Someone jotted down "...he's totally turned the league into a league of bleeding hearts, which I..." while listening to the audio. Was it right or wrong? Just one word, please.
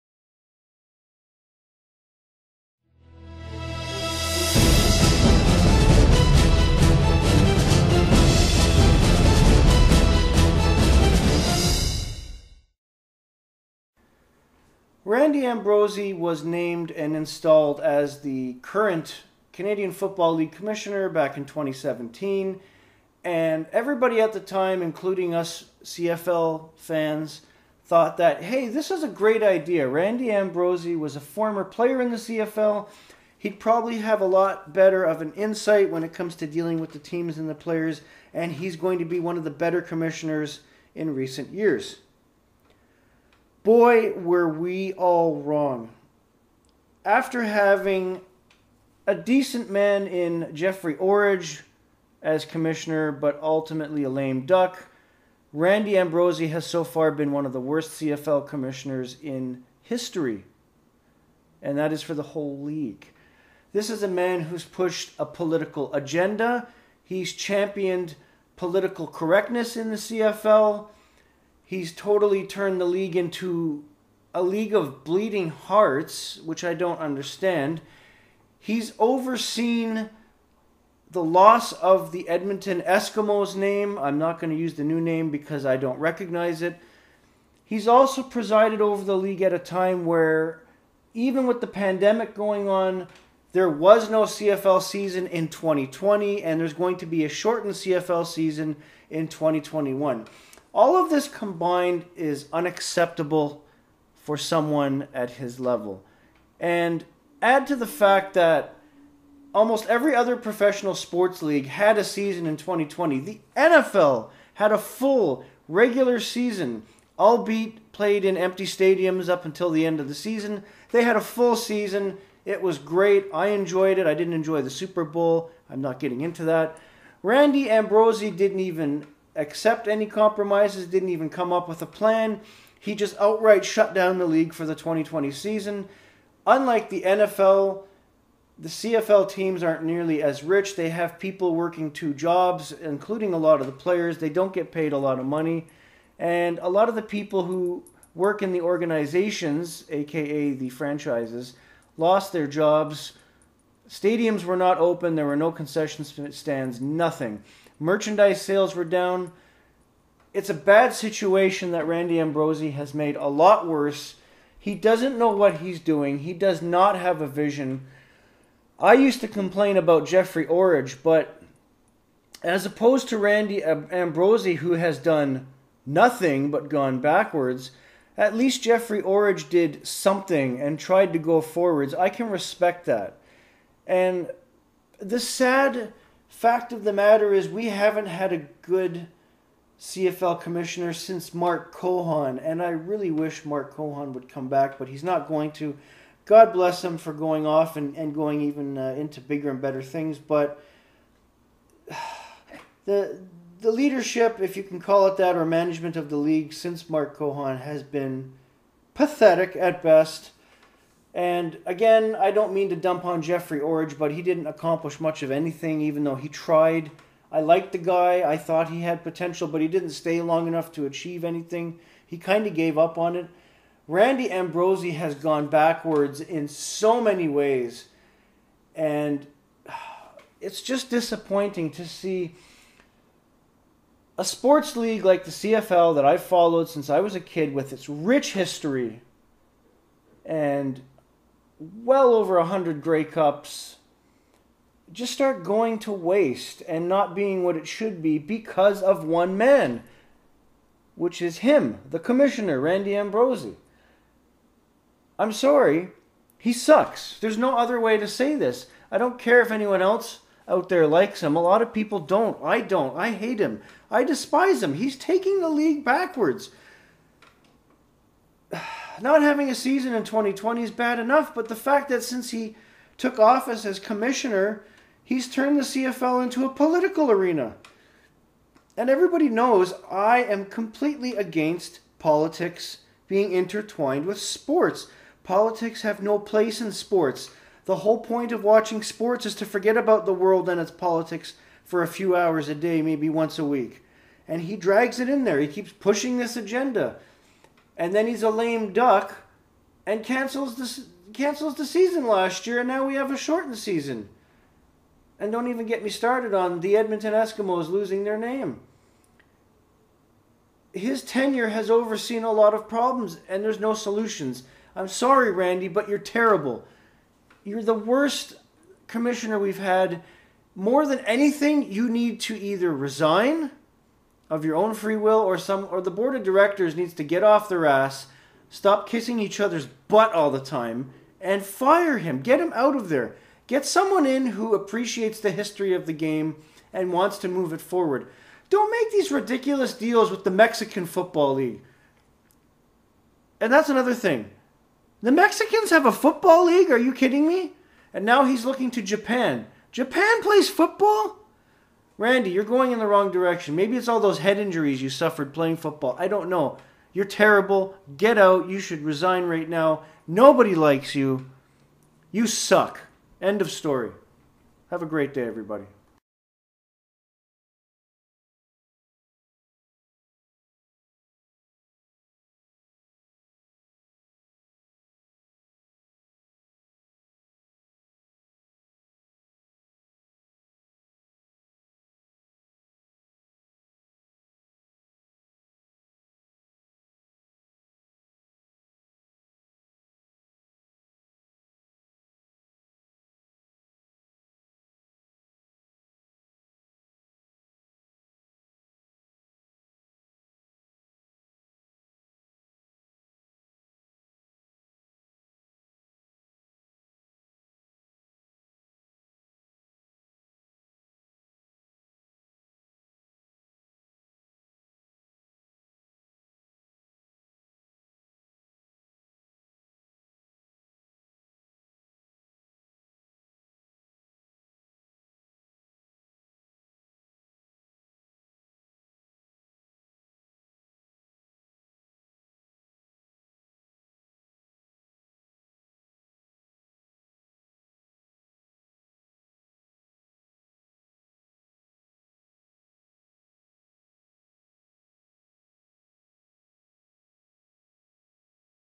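right.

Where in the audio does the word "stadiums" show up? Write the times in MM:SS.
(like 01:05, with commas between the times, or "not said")
01:58, 02:33.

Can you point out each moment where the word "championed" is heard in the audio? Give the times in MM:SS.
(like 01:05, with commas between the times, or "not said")
01:07.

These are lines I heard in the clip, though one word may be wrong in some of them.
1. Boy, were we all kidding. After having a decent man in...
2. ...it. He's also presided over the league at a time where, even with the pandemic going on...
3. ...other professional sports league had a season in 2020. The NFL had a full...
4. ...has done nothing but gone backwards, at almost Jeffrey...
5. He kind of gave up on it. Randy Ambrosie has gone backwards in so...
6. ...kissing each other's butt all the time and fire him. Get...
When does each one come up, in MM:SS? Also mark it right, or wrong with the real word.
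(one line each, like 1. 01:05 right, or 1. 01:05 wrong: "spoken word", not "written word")
1. 00:43 wrong: "wrong", not "kidding"
2. 01:26 right
3. 01:50 right
4. 02:54 wrong: "least", not "almost"
5. 03:42 right
6. 05:28 right.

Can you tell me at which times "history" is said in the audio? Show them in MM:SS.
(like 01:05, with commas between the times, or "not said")
00:59, 03:58, 05:35.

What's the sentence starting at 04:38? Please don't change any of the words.
And everybody knows I am completely against politics being intertwined with sports.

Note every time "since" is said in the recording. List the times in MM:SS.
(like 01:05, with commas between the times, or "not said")
03:10, 03:26, 03:56, 04:32.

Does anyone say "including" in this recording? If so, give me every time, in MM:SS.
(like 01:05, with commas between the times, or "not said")
00:24, 02:22.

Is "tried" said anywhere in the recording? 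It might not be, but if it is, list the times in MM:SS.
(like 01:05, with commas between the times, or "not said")
03:00, 03:36.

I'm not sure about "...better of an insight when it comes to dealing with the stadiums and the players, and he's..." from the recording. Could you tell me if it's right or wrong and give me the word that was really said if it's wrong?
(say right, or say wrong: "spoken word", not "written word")
wrong: "teams", not "stadiums".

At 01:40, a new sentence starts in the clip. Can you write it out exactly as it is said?
All of this combined is unacceptable for someone at his level.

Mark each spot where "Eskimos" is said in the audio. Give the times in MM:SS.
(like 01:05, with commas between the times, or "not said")
01:22, 05:07.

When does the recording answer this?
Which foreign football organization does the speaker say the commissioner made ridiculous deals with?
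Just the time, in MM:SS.
05:40.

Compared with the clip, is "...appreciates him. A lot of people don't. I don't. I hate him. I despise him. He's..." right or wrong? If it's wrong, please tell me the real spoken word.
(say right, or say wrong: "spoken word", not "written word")
wrong: "likes", not "appreciates".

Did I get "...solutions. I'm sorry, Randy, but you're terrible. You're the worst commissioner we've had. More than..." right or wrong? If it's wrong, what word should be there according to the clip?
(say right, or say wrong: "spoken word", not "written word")
right.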